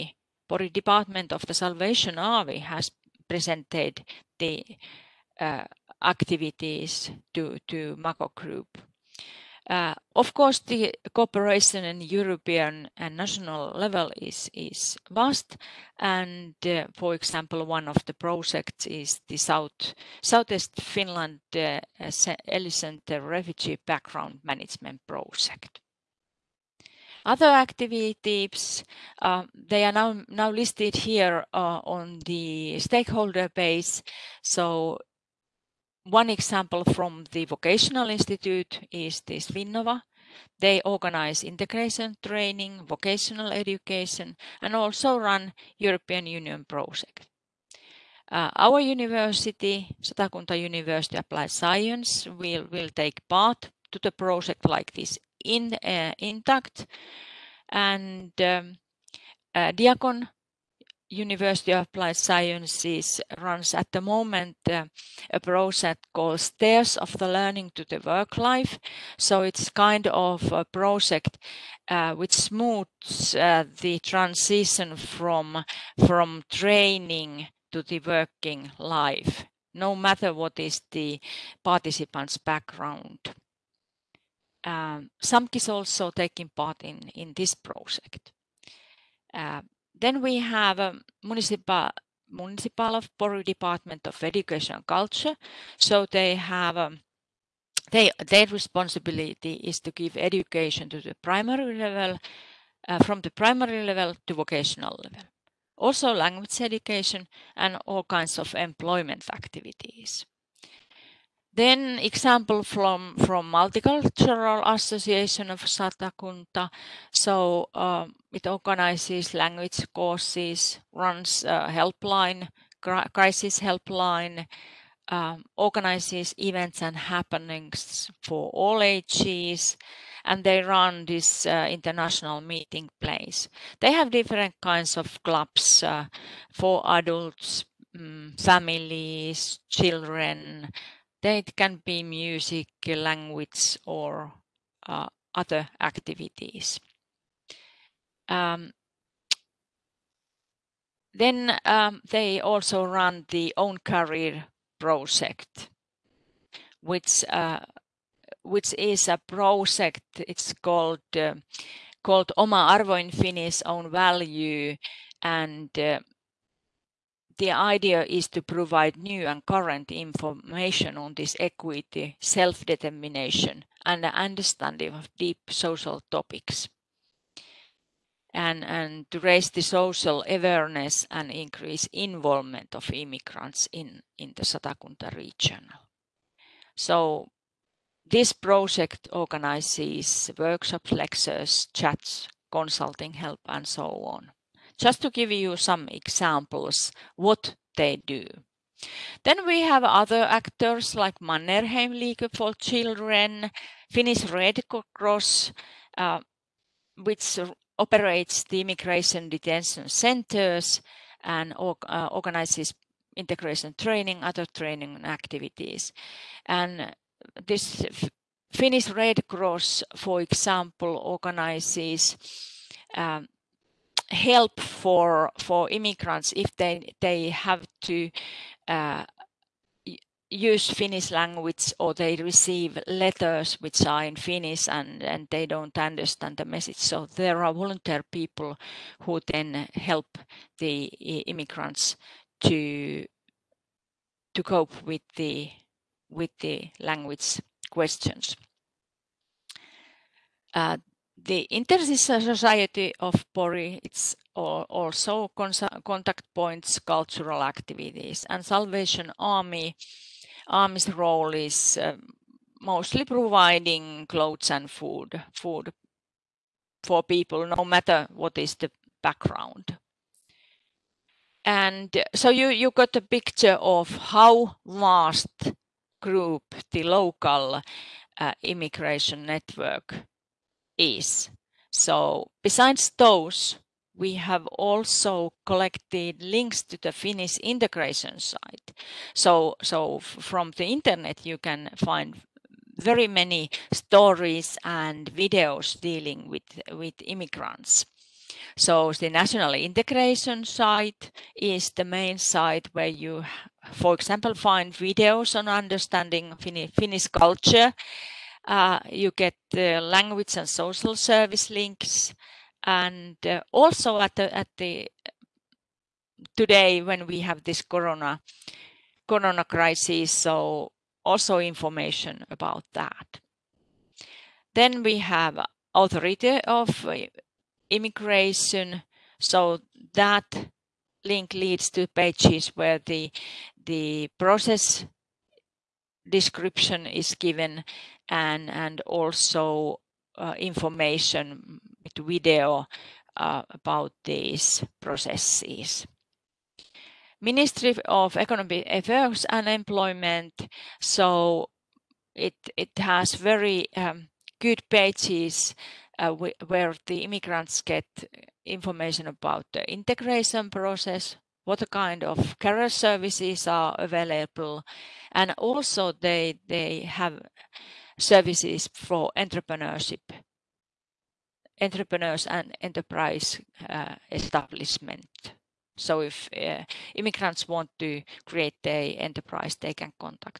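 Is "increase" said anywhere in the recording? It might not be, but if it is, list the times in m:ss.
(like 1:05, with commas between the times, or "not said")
3:01.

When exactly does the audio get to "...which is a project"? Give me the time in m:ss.
2:38.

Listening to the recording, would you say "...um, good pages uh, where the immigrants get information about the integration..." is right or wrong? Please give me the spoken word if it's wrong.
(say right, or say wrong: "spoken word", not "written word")
right.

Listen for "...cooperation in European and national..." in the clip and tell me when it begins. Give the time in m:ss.
0:11.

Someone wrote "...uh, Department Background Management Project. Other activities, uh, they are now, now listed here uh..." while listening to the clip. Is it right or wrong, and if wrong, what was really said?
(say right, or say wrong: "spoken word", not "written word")
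wrong: "Refugee", not "Department".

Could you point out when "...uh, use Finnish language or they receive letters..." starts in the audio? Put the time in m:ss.
3:48.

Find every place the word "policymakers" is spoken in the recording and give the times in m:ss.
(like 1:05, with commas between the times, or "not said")
not said.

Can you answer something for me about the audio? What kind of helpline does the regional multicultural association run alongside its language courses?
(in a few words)
Crisis helpline.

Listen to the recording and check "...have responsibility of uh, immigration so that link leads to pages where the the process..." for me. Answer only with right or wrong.
wrong.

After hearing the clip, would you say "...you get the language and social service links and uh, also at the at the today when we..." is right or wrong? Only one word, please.
right.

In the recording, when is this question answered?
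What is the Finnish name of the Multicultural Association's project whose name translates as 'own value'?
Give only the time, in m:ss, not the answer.
2:42.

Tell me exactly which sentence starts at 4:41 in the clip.
So besides those we have also collected links to the Finnish integration site.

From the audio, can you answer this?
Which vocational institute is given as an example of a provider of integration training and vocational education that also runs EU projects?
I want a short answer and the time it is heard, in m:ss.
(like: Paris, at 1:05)
WinNova, at 0:39.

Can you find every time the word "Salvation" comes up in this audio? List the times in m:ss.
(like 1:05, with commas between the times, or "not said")
0:01, 4:18.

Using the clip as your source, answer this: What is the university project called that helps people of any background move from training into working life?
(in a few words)
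Stairs of the Learning to the Work Life.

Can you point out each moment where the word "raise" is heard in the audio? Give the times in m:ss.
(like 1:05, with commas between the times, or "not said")
2:59.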